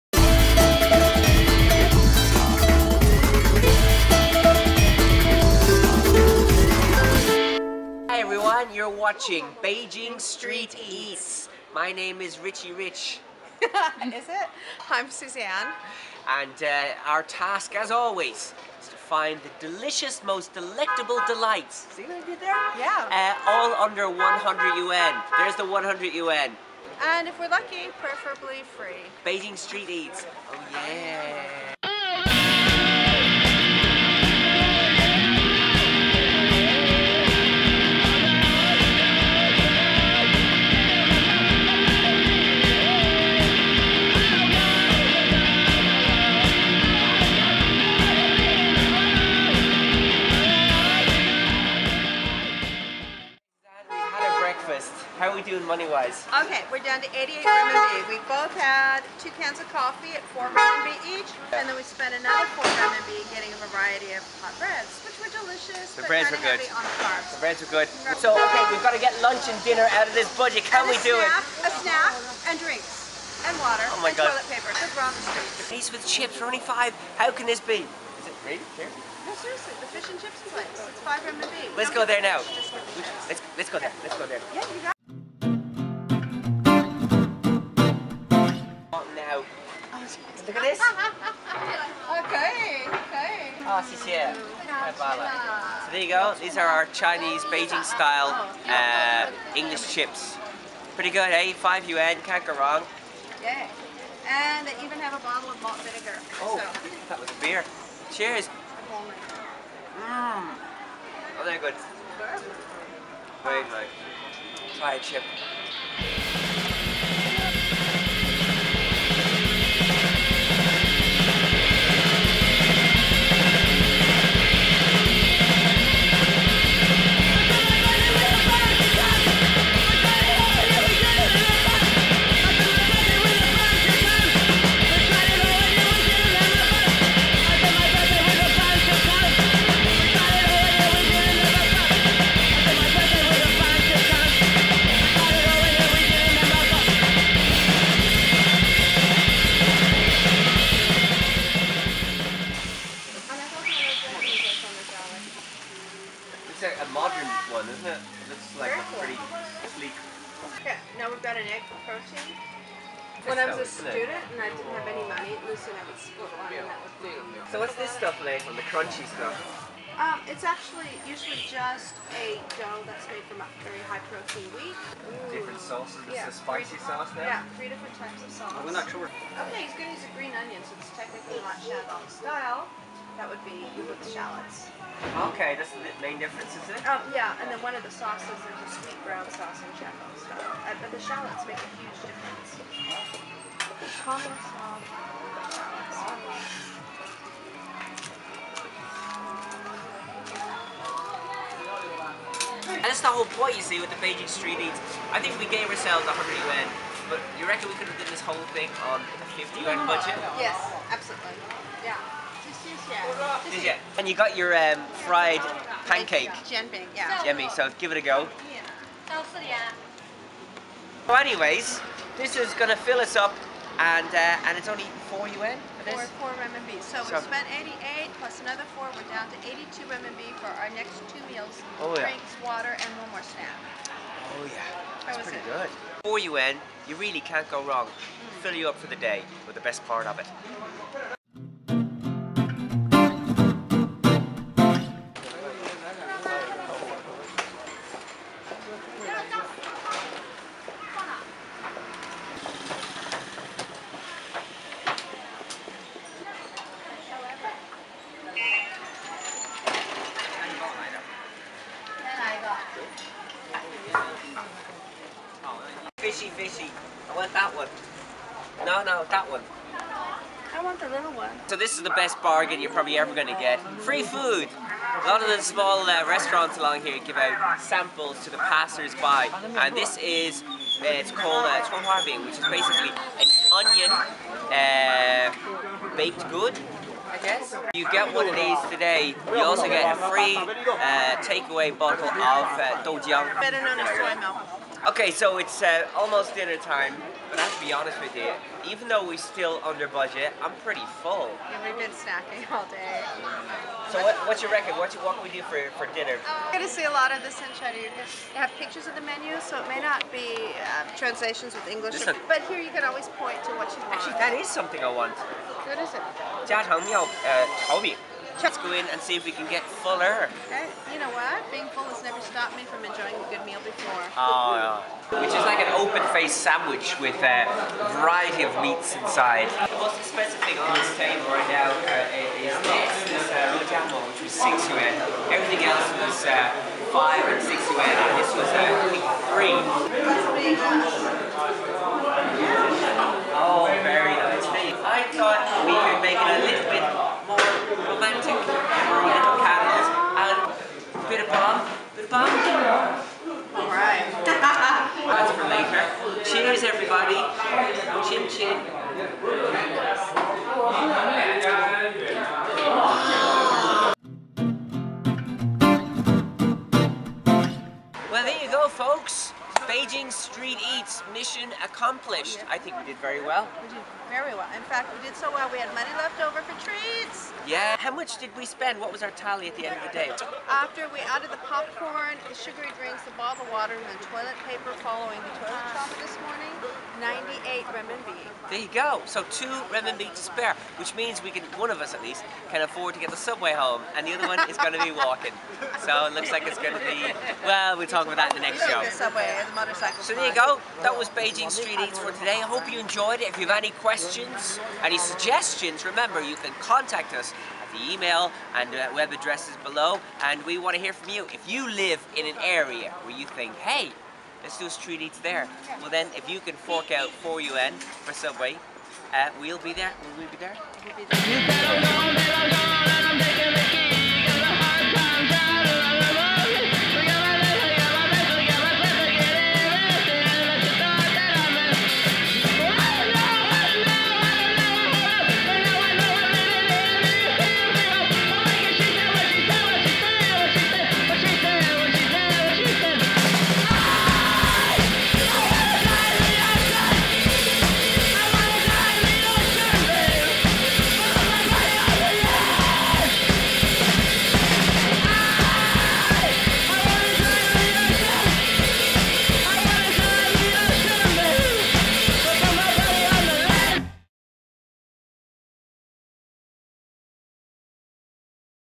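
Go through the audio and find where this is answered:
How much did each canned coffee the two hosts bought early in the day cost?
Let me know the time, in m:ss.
1:00.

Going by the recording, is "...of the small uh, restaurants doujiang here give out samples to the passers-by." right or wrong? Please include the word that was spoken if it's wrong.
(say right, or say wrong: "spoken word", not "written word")
wrong: "along", not "doujiang".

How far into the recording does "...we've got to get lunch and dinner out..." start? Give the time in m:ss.
1:08.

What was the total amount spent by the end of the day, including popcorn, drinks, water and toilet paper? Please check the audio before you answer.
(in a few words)
98 renminbi.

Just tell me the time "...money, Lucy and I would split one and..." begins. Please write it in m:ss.
2:45.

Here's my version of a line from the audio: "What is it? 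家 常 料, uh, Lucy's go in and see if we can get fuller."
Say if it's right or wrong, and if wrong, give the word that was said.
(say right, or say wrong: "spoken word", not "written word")
wrong: "Let", not "Lucy".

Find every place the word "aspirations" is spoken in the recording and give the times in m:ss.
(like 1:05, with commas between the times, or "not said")
not said.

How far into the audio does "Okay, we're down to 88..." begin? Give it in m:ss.
0:56.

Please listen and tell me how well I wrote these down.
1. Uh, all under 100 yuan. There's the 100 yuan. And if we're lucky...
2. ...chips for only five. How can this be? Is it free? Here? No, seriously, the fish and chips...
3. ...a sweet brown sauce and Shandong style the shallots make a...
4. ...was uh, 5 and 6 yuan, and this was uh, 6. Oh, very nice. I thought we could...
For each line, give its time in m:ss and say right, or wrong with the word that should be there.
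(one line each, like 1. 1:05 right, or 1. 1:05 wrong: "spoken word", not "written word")
1. 0:23 right
2. 1:16 right
3. 3:08 right
4. 5:35 wrong: "3", not "6".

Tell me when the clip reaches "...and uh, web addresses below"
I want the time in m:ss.
6:48.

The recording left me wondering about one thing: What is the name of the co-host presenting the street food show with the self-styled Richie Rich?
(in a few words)
Suzanne.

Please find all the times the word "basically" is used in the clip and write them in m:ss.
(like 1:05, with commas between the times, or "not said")
4:42.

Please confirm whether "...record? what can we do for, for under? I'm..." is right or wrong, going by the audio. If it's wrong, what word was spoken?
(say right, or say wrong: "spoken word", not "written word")
wrong: "dinner", not "under".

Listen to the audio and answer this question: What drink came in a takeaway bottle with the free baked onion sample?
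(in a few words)
Soy milk.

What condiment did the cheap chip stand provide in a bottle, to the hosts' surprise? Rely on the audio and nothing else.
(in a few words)
Malt vinegar.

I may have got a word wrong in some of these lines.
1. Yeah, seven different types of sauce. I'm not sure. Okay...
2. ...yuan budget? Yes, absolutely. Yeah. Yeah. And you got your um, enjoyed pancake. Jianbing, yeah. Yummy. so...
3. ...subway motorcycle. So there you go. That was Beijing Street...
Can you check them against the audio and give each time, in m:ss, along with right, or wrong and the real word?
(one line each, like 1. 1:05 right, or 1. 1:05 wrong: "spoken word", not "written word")
1. 2:57 wrong: "three", not "seven"
2. 3:29 wrong: "fried", not "enjoyed"
3. 6:38 right.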